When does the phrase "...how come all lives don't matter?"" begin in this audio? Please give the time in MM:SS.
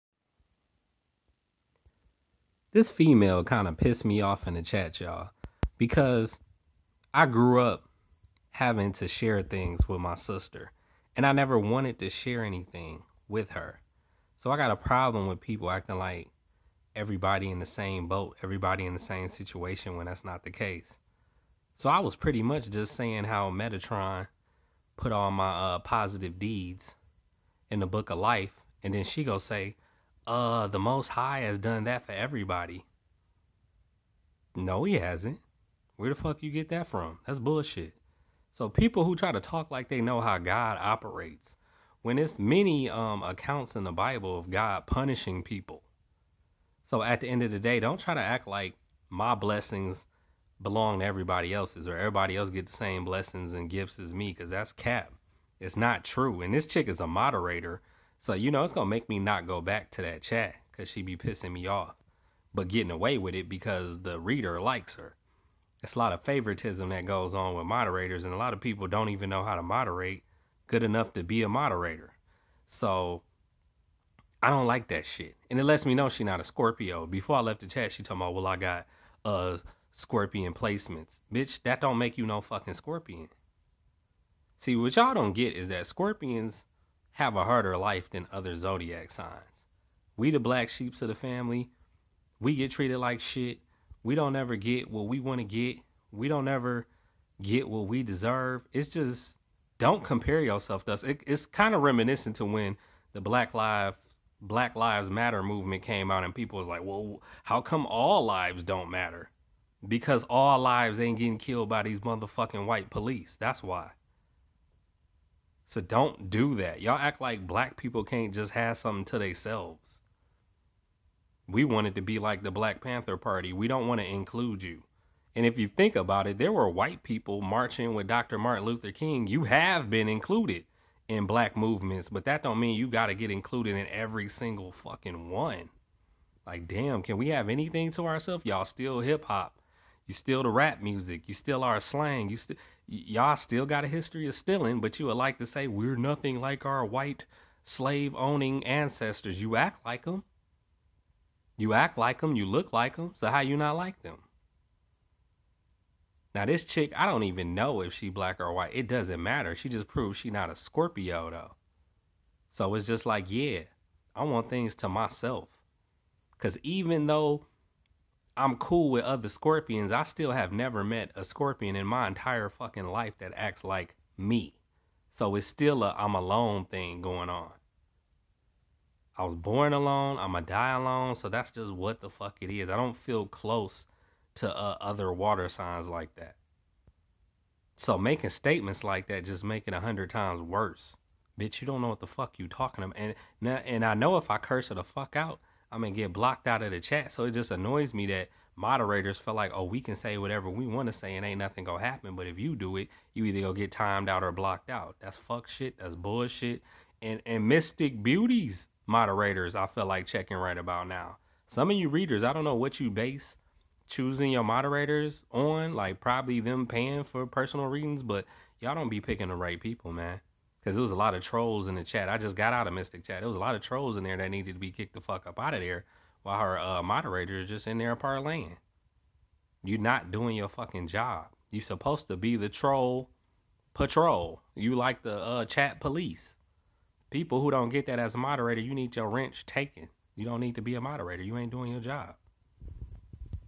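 01:47.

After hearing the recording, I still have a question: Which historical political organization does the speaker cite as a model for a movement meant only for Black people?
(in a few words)
Black Panther Party.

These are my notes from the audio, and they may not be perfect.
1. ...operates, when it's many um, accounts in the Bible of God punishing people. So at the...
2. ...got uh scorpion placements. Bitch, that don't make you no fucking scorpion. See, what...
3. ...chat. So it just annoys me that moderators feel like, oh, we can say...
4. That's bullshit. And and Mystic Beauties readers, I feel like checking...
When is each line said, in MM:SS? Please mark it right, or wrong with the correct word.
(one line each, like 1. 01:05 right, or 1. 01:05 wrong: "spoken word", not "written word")
1. 00:40 right
2. 01:18 right
3. 03:16 right
4. 03:25 wrong: "moderators", not "readers".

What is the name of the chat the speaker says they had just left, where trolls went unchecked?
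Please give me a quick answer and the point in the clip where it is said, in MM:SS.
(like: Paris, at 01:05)
Mystic Chat, at 03:42.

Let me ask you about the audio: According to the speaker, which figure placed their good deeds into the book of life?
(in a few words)
Metatron.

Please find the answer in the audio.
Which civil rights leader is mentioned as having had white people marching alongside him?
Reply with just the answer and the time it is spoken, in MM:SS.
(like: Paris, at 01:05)
Dr. Martin Luther King, at 02:08.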